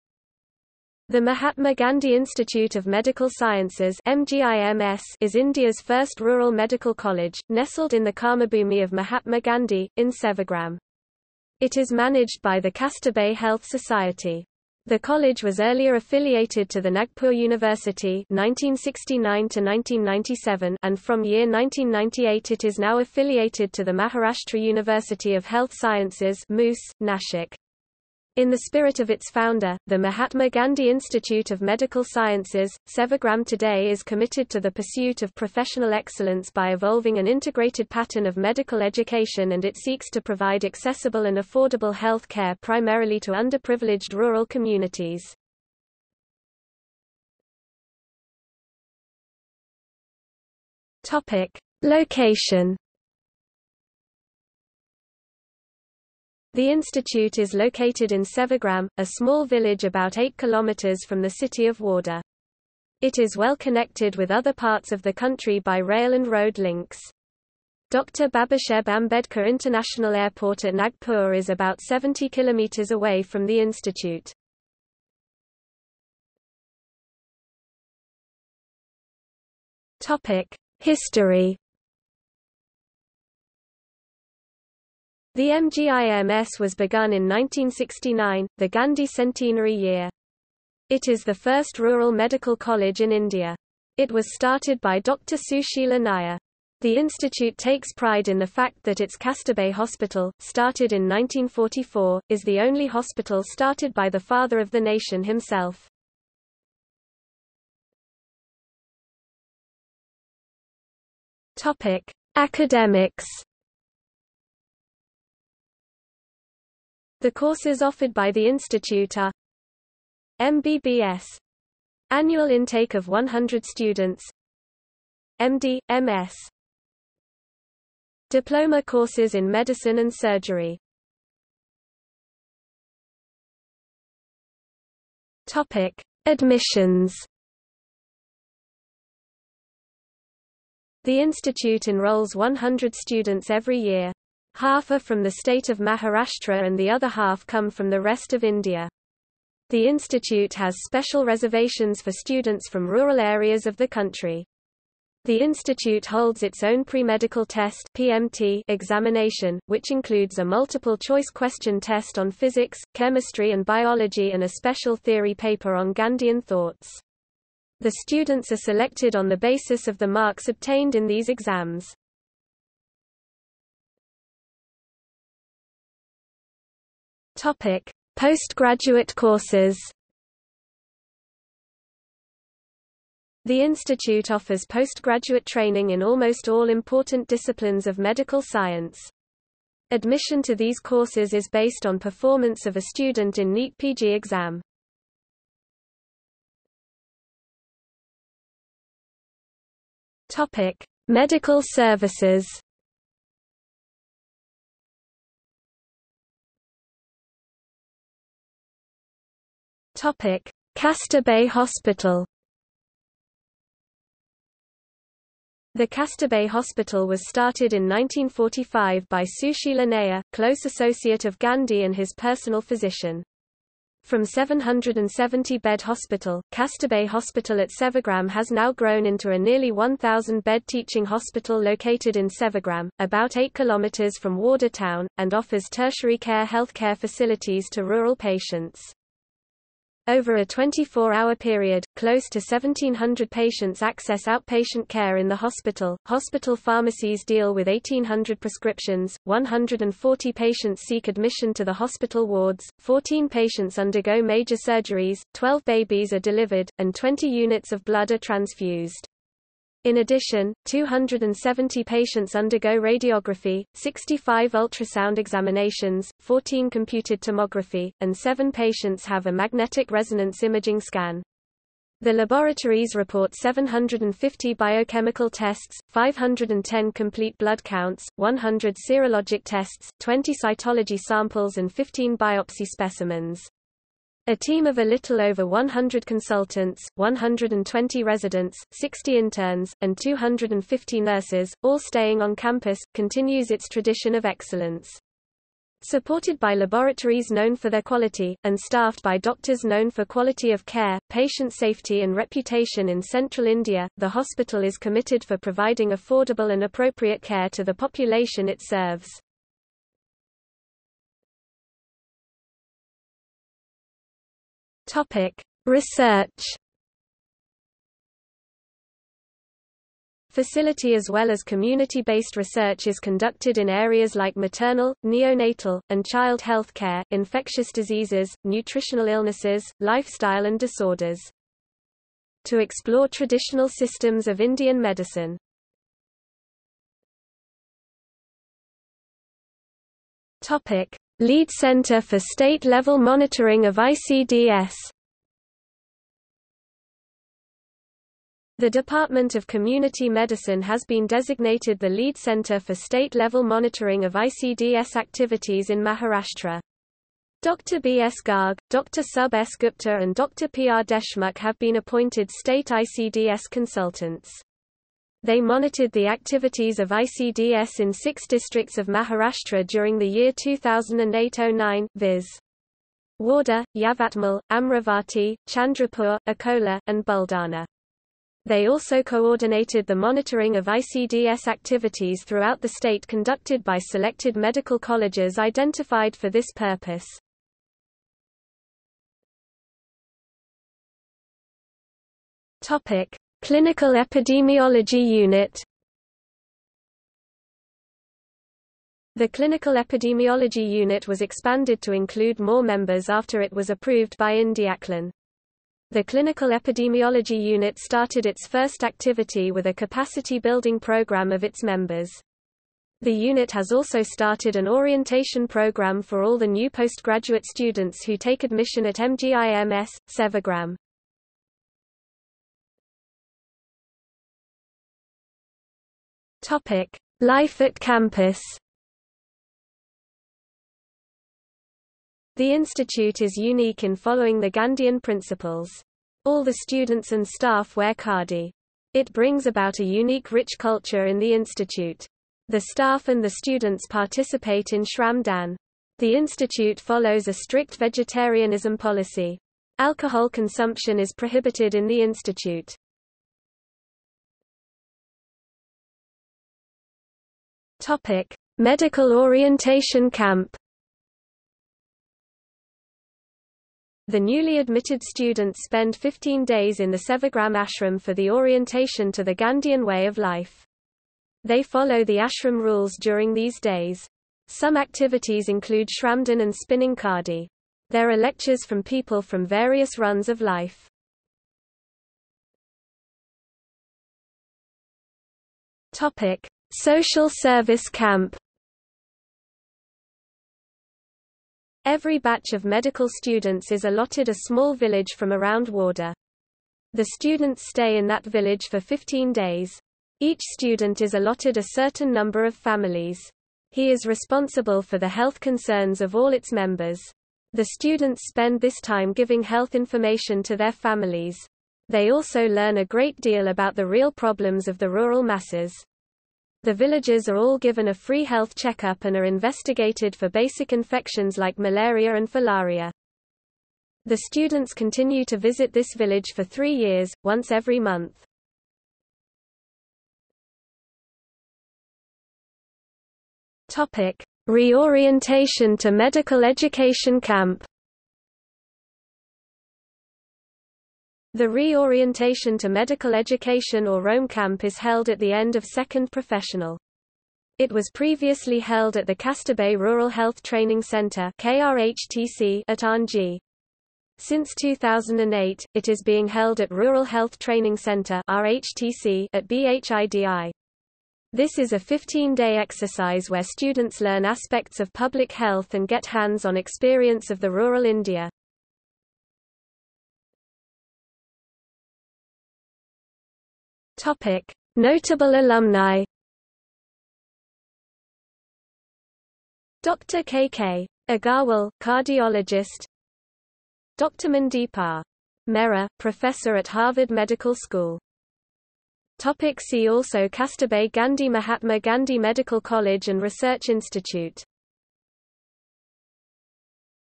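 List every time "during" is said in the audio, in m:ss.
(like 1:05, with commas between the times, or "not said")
6:09, 7:53.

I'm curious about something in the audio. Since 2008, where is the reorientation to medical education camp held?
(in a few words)
BHIDI.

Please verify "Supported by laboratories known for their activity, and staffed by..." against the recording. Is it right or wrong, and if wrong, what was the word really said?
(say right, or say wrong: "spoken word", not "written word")
wrong: "quality", not "activity".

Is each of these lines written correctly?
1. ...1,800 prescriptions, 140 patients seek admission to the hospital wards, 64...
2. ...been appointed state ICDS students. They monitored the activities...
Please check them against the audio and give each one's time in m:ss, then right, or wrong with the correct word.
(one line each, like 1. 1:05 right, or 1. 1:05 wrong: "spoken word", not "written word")
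1. 4:07 wrong: "14", not "64"
2. 6:01 wrong: "consultants", not "students".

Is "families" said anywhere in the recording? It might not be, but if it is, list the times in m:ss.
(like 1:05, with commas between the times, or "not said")
8:22, 8:30.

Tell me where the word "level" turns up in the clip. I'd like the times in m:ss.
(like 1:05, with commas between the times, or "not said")
5:42, 5:52.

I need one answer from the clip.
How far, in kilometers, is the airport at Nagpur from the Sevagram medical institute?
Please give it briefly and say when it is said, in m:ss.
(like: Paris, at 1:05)
70 kilometers, at 1:11.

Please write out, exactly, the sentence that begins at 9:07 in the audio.
It was previously held at the Kasturba Rural Health Training Center KRHTC at Anji.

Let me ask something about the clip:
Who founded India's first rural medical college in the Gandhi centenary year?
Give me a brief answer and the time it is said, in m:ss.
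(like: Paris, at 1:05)
Dr. Sushila Nair, at 1:34.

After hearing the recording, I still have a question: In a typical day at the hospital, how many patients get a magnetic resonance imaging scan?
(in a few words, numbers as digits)
7.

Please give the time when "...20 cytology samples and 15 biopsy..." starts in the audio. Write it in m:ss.
4:39.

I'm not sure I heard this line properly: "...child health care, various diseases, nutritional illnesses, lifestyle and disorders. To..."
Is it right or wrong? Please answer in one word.
wrong.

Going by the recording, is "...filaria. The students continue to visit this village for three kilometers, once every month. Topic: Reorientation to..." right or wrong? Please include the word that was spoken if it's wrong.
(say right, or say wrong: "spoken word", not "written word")
wrong: "years", not "kilometers".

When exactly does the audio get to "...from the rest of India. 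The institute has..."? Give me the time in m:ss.
2:27.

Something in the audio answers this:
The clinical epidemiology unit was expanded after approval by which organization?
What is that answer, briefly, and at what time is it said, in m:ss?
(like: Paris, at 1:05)
IndiaCLEN, at 6:44.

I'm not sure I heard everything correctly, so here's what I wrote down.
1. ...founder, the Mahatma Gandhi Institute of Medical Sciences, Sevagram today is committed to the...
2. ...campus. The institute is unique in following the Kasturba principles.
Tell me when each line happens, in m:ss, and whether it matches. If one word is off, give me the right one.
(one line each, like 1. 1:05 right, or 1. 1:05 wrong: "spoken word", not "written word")
1. 0:29 right
2. 7:07 wrong: "Gandhian", not "Kasturba".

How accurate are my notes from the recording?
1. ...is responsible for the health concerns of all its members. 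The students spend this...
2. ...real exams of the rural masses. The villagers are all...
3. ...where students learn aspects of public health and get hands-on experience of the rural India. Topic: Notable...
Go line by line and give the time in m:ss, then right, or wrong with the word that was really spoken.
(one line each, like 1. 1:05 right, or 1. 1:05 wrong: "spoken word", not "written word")
1. 8:23 right
2. 8:33 wrong: "problems", not "exams"
3. 9:23 right.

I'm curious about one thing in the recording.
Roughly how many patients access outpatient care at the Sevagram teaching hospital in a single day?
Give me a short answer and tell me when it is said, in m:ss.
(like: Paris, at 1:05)
1,700, at 4:02.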